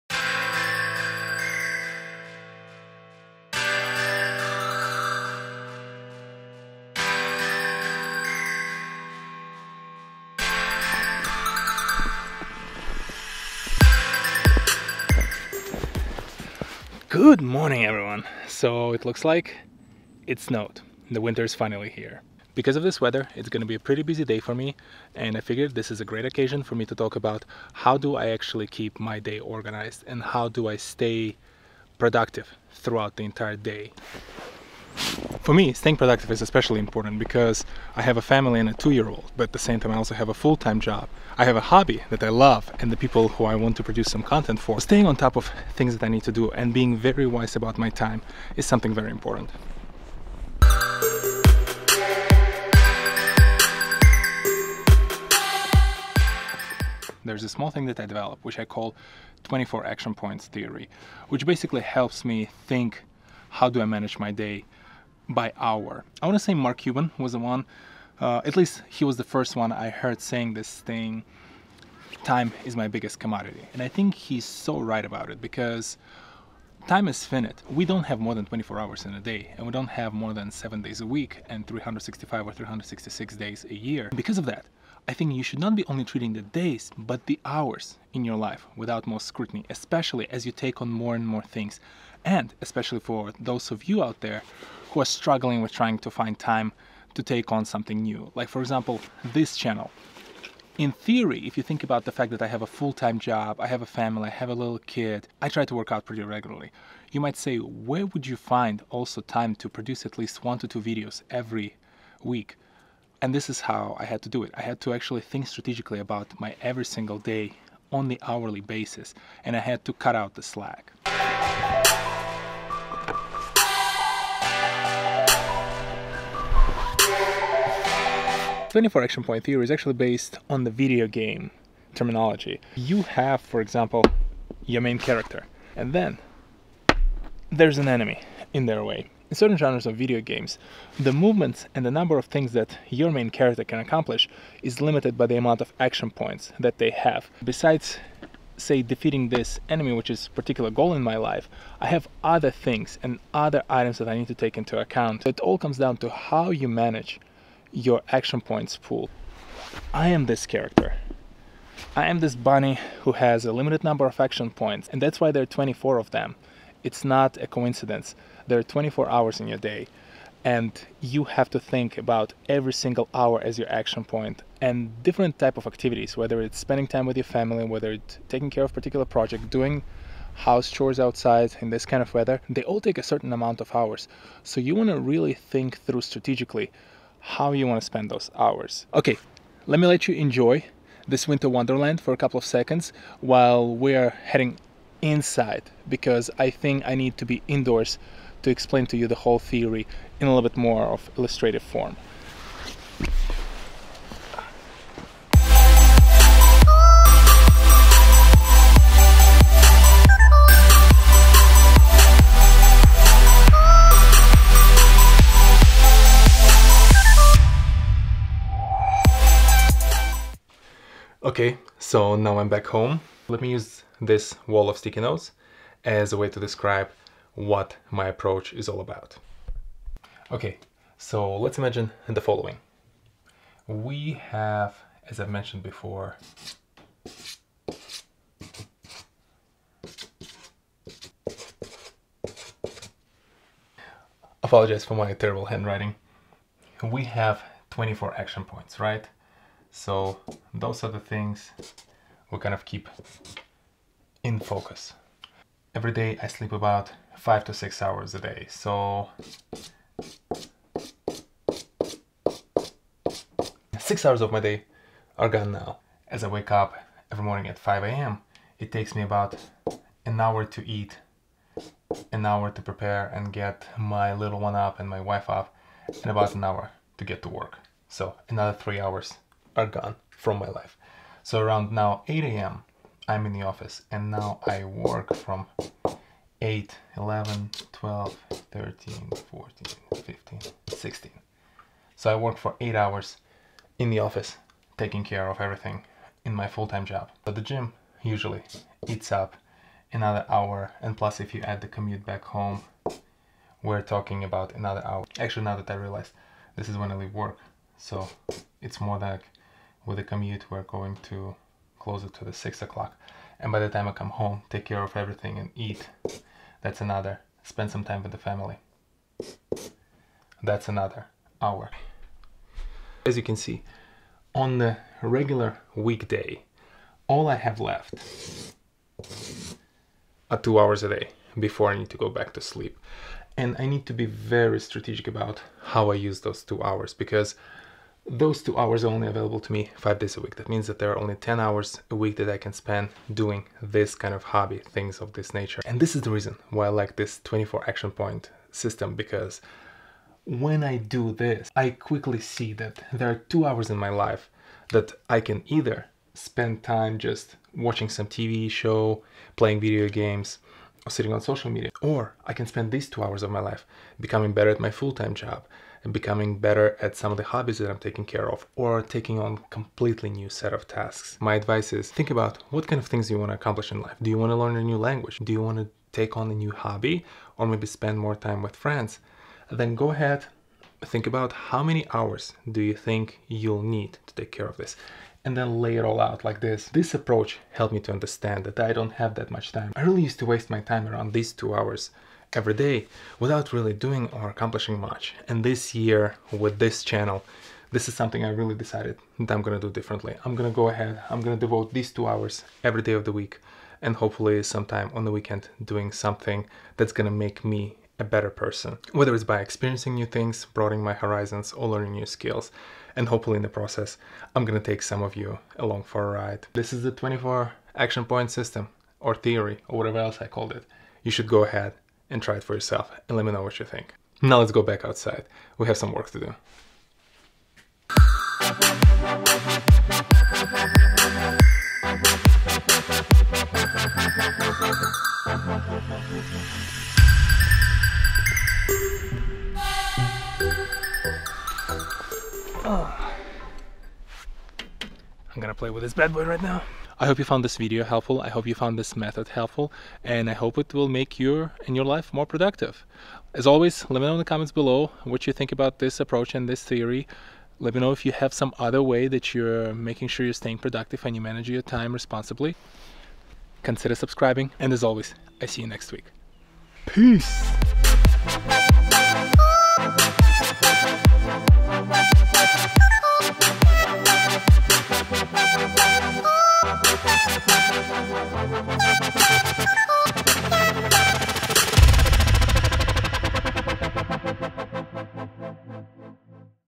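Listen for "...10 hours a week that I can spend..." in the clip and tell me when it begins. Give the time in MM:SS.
05:41.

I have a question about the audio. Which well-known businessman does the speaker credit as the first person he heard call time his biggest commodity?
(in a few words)
Mark Cuban.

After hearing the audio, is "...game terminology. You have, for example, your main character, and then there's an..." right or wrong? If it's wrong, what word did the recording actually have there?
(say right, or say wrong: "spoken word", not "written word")
right.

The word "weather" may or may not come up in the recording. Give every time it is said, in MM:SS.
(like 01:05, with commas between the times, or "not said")
00:23, 03:02.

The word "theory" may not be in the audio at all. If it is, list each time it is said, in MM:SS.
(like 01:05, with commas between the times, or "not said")
01:00, 01:40, 02:09, 03:19, 06:59, 07:36.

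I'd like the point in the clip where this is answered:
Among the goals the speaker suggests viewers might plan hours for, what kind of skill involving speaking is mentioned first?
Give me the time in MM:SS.
06:14.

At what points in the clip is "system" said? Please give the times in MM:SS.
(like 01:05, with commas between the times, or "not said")
05:48, 06:58.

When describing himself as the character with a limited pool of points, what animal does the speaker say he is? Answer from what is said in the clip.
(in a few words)
bunny.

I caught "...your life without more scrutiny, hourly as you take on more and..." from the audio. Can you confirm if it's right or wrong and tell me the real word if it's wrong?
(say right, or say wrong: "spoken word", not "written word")
wrong: "especially", not "hourly".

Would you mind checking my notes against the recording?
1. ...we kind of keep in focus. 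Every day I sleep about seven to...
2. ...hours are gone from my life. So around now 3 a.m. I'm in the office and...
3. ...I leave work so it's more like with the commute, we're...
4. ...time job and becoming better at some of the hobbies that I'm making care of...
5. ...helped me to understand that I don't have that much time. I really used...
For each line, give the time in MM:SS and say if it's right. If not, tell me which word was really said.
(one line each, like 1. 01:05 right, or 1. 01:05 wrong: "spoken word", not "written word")
1. 04:12 wrong: "five", not "seven"
2. 04:38 wrong: "8", not "3"
3. 05:06 right
4. 06:04 wrong: "taking", not "making"
5. 06:27 right.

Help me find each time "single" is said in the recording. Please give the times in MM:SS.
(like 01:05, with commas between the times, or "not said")
01:56, 02:52.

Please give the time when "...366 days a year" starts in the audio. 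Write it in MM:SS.
01:22.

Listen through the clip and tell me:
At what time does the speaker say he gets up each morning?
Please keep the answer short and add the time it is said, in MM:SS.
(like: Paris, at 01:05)
5 a.m., at 04:27.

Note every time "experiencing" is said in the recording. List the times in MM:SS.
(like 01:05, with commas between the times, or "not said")
06:49.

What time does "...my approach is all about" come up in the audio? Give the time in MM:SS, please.
03:47.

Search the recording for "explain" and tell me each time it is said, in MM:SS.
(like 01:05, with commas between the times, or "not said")
03:18.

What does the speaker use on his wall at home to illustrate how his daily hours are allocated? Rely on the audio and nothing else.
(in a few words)
sticky notes.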